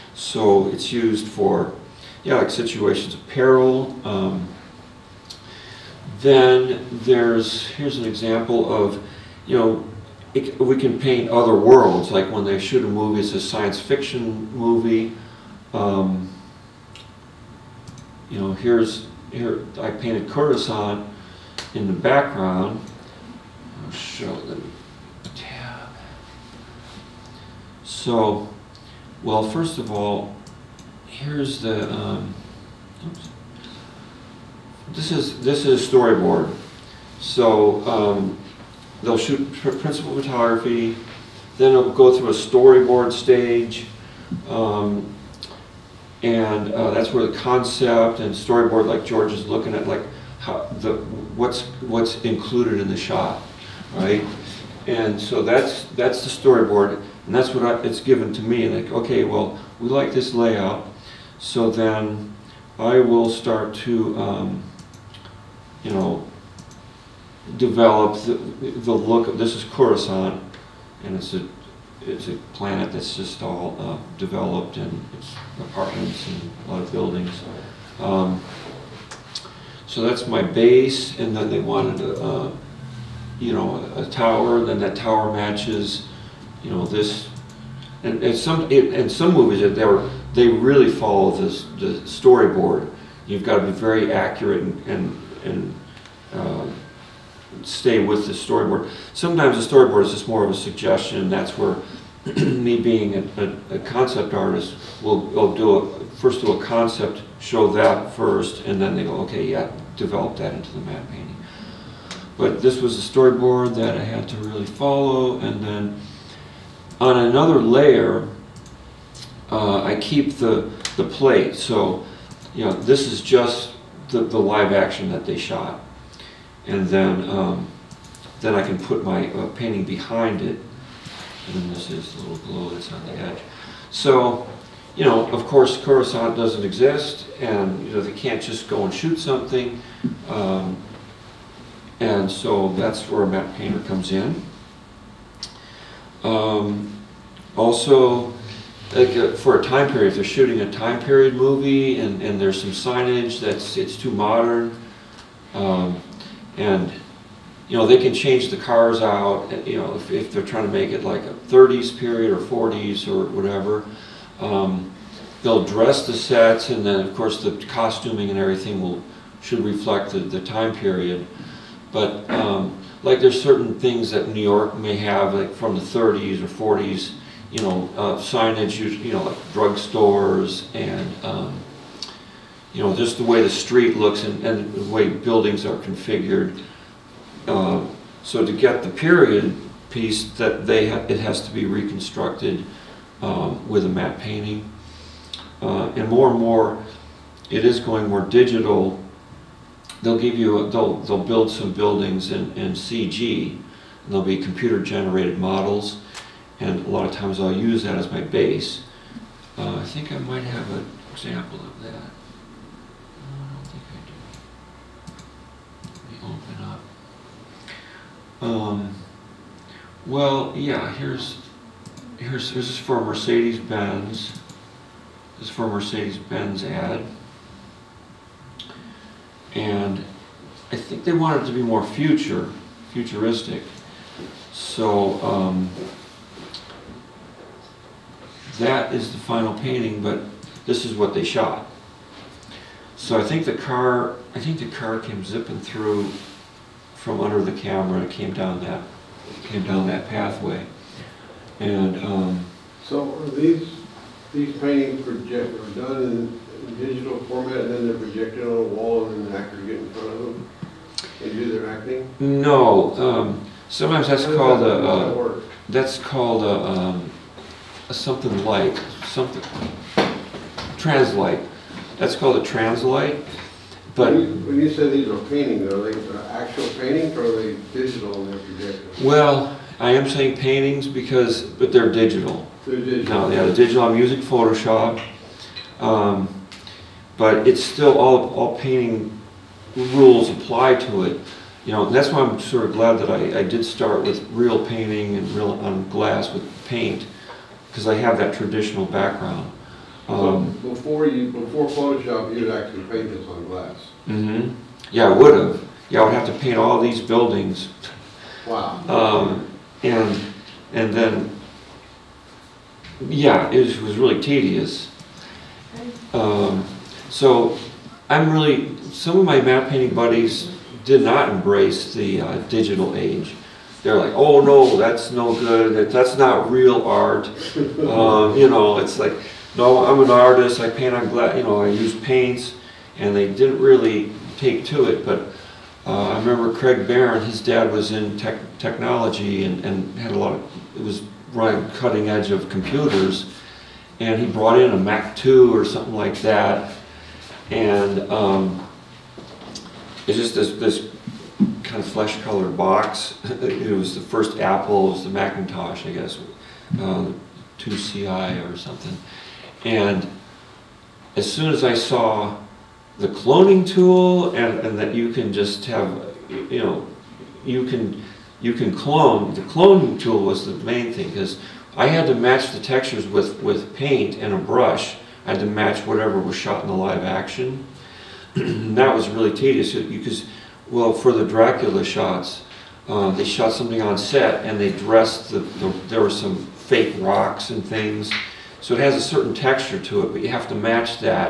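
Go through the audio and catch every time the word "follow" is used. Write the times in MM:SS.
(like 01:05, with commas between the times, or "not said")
01:30, 01:54.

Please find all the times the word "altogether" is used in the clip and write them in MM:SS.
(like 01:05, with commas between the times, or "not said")
not said.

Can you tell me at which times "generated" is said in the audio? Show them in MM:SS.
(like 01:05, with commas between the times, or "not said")
03:24.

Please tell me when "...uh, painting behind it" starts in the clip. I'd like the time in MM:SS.
02:09.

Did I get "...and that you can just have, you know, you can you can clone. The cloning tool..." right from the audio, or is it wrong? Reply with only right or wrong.
right.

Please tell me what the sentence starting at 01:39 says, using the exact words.
Sometimes the storyboard is just more of a suggestion.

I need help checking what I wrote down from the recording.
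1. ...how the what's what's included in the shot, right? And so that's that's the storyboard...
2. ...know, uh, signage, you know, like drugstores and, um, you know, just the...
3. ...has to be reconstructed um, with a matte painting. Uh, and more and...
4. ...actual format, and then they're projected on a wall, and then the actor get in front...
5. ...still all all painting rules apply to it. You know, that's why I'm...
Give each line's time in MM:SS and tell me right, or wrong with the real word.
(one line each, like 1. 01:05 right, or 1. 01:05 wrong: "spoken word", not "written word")
1. 00:50 right
2. 02:57 right
3. 03:11 right
4. 04:16 wrong: "digital", not "actual"
5. 04:47 right.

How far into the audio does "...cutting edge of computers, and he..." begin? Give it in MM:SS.
05:41.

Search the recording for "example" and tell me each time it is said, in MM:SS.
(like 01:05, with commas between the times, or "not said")
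00:08, 03:31.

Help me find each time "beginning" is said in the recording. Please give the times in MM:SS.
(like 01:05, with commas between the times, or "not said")
not said.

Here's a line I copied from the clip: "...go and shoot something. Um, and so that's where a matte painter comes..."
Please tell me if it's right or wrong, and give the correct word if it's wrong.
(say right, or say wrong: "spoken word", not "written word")
right.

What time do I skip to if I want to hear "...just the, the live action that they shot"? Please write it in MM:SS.
02:03.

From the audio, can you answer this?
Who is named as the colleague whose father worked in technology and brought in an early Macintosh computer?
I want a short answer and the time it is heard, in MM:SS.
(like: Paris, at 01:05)
Craig Barron, at 05:36.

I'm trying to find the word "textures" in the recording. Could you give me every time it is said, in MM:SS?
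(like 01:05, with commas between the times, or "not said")
06:12, 06:29.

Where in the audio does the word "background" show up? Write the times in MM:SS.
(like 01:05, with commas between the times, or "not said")
00:21, 04:58.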